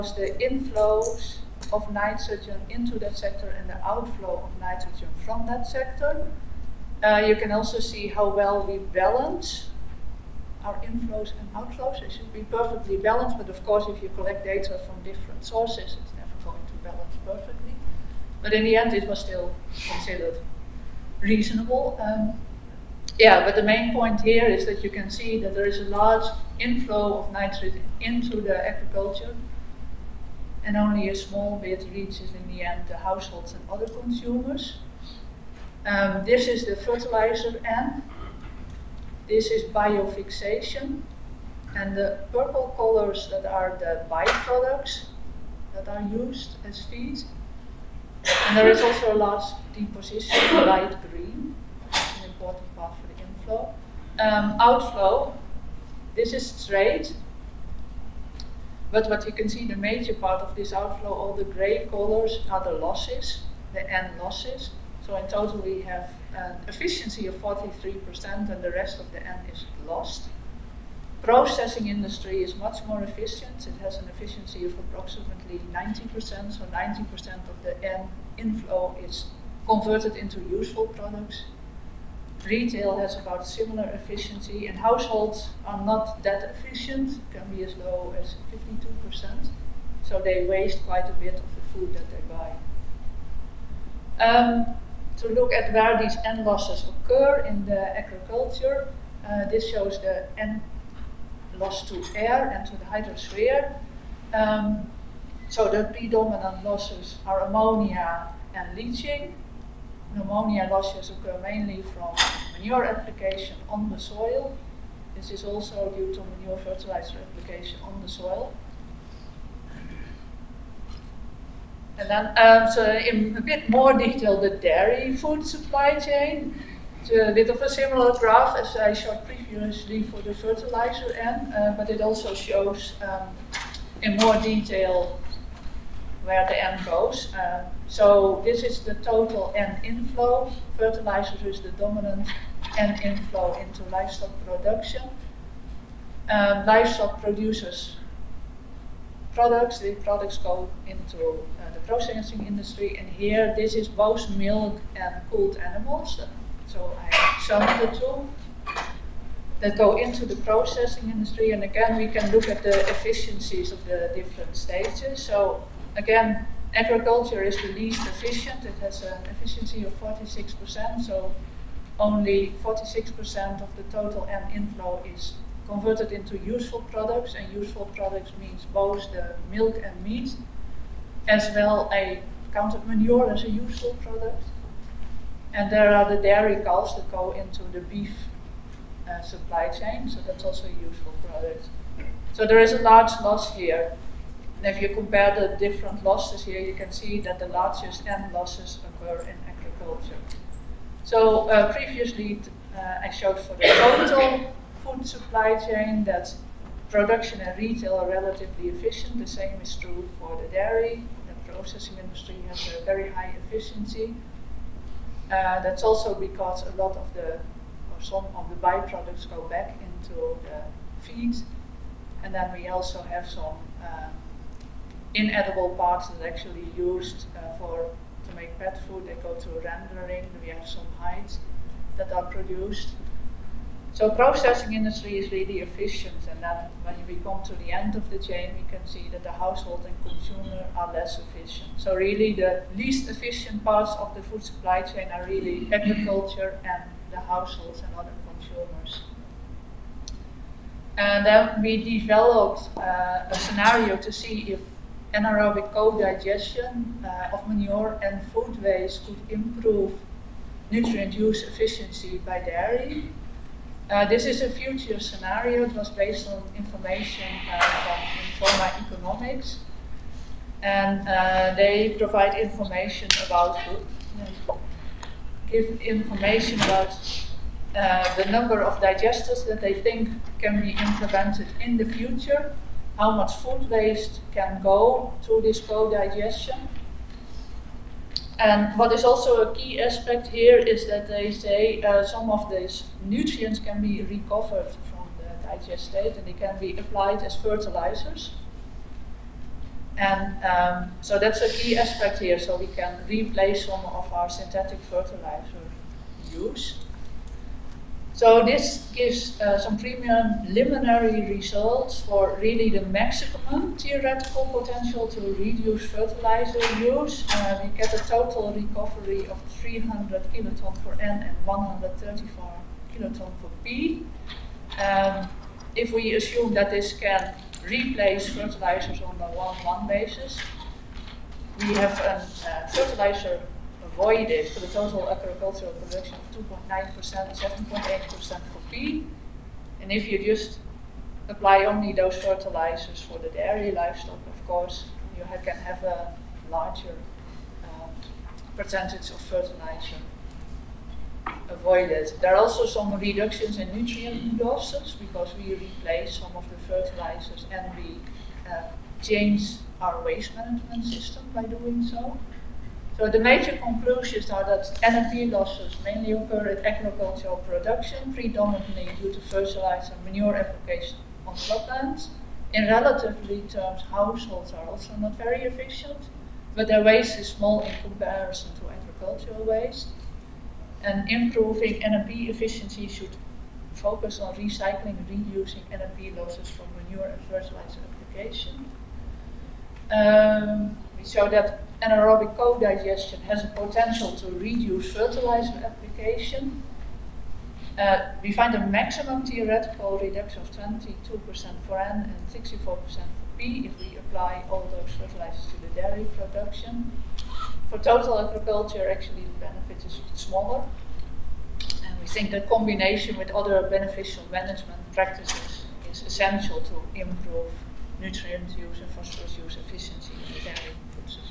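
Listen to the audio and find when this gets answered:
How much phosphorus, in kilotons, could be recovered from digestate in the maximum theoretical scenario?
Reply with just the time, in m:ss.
5:21.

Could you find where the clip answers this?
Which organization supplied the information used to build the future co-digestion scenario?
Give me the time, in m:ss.
4:28.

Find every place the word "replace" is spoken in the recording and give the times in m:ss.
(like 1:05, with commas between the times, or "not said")
5:03, 5:27, 5:55.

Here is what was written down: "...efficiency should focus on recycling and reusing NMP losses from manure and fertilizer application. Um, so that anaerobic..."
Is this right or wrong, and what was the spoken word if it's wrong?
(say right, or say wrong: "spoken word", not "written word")
right.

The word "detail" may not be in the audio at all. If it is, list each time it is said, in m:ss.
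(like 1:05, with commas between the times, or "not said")
2:03, 2:14.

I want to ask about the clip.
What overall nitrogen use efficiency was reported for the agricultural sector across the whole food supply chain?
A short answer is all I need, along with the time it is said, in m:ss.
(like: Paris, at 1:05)
43%, at 1:07.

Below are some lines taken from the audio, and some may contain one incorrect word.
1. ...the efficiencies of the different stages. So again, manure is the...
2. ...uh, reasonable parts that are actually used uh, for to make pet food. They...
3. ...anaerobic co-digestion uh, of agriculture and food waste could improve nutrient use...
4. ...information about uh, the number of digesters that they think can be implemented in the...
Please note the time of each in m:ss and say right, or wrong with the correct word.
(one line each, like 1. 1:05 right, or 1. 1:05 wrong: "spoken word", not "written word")
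1. 2:42 wrong: "agriculture", not "manure"
2. 3:43 wrong: "inedible", not "reasonable"
3. 4:15 wrong: "manure", not "agriculture"
4. 4:35 right.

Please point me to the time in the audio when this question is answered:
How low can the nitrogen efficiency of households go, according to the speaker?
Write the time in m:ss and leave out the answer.
1:28.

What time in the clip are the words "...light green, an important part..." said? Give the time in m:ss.
0:50.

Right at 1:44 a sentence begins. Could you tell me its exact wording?
Um, so the predominant losses are ammonia and leaching ammonia losses occur mainly from manure application on the soil.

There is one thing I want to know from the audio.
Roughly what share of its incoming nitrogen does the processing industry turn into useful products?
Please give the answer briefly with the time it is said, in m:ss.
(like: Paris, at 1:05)
90%, at 1:14.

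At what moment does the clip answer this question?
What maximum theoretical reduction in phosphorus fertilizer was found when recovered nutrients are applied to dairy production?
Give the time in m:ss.
6:42.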